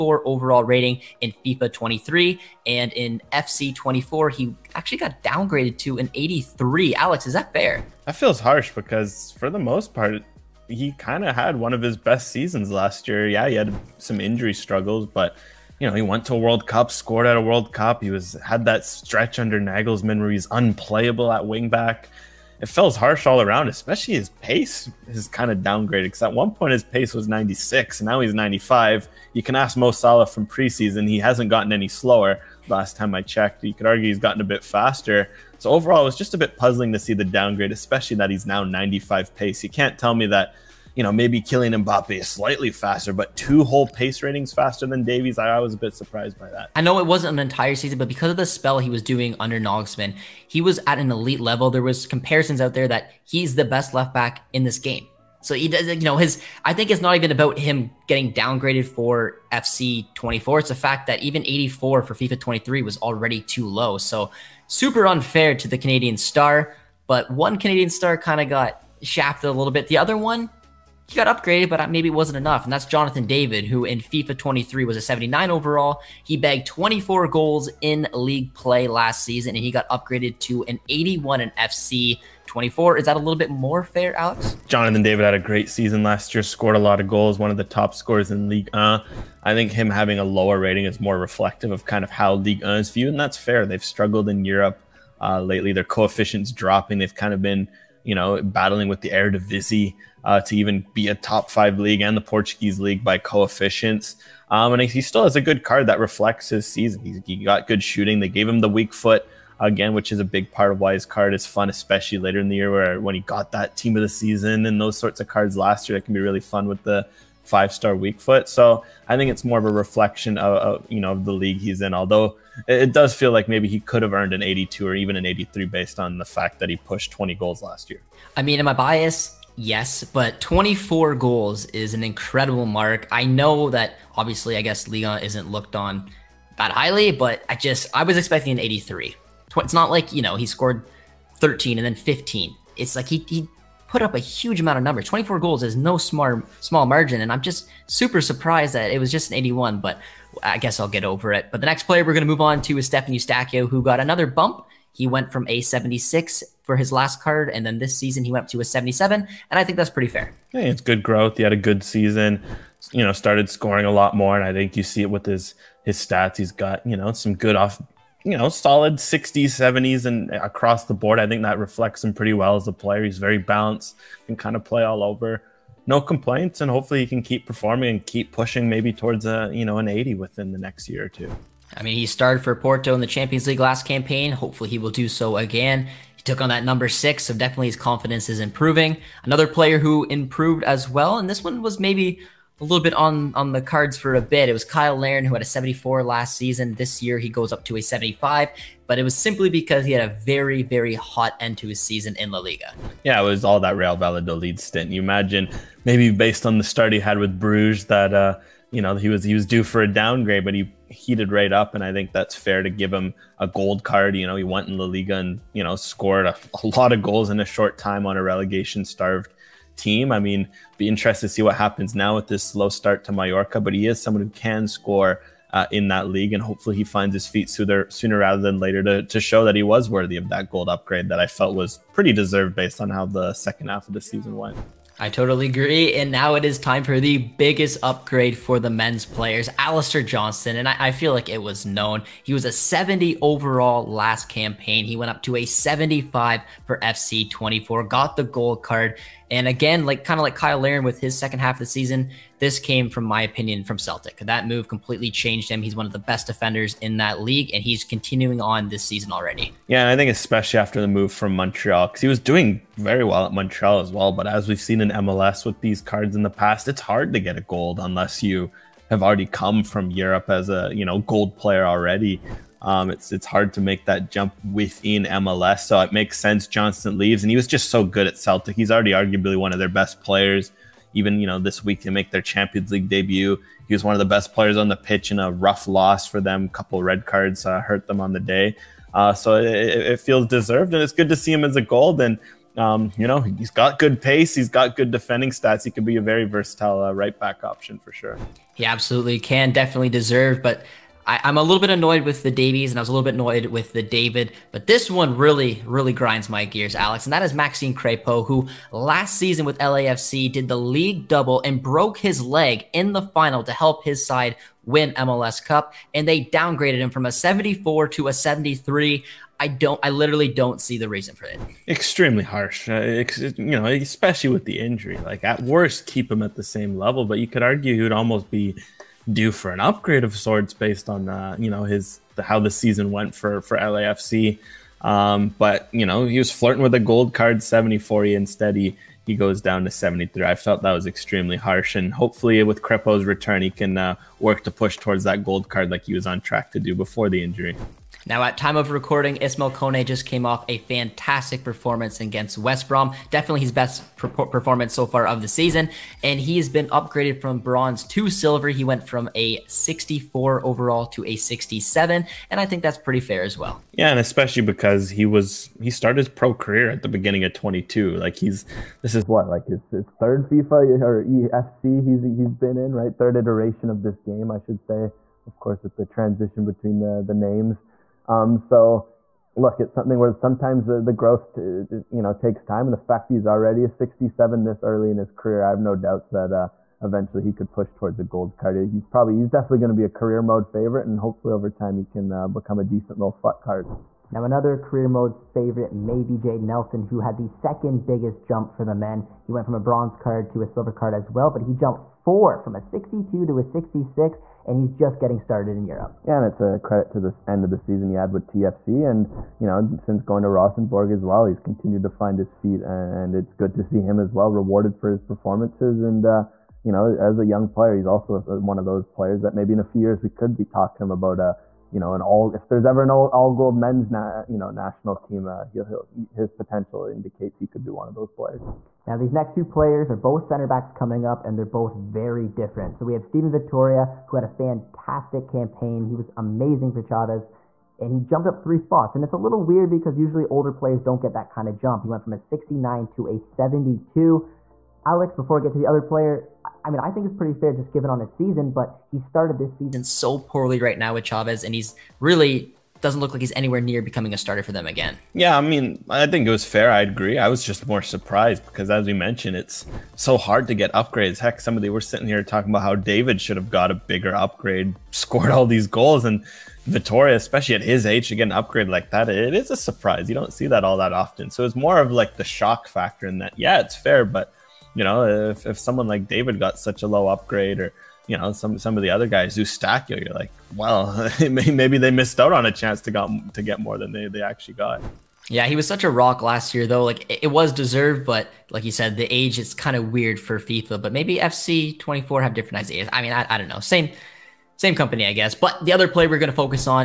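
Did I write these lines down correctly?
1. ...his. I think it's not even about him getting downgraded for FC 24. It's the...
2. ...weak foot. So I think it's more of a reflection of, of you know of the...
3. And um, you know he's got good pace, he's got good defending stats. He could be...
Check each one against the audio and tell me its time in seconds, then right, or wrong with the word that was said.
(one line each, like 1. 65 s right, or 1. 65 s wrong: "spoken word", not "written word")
1. 56 s right
2. 117 s right
3. 291 s right.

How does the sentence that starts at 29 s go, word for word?
You can ask Mo Salah from preseason; he hasn't gotten any slower.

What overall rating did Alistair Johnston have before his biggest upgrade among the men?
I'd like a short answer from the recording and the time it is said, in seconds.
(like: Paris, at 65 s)
70, at 242 s.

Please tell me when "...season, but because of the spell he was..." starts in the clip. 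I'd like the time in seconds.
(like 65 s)
47 s.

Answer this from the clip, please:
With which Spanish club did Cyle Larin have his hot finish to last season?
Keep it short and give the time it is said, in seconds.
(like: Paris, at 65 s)
Real Valladolid, at 203 s.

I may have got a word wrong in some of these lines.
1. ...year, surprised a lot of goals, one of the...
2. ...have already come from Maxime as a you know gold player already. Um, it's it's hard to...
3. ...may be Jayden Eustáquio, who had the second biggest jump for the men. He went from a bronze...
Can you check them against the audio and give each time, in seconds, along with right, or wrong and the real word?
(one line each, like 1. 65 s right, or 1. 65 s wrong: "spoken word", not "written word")
1. 86 s wrong: "scored", not "surprised"
2. 268 s wrong: "Europe", not "Maxime"
3. 395 s wrong: "Nelson", not "Eustáquio".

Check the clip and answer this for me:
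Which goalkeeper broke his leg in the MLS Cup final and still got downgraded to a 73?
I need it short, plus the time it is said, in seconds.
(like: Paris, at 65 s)
Maxime Crepeau, at 307 s.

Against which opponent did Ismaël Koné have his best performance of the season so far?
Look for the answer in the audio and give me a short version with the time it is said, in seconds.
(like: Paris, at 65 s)
West Brom, at 352 s.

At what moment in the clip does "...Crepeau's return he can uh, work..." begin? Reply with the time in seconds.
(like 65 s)
342 s.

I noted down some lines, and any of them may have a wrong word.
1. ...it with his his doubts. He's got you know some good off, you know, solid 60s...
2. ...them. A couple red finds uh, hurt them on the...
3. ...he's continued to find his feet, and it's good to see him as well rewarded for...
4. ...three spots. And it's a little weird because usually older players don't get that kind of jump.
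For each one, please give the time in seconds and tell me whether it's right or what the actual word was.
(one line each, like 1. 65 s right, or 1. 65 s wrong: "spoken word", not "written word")
1. 165 s wrong: "stats", not "doubts"
2. 286 s wrong: "cards", not "finds"
3. 411 s right
4. 438 s right.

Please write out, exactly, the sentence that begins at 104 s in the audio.
Um, and he still has a good card that reflects his season.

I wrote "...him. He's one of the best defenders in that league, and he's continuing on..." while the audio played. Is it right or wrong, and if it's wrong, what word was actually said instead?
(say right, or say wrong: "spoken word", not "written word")
right.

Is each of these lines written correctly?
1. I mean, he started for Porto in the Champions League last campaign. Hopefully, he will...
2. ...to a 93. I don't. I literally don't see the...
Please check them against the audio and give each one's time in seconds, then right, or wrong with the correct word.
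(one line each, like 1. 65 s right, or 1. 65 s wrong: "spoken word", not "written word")
1. 181 s right
2. 317 s wrong: "73", not "93".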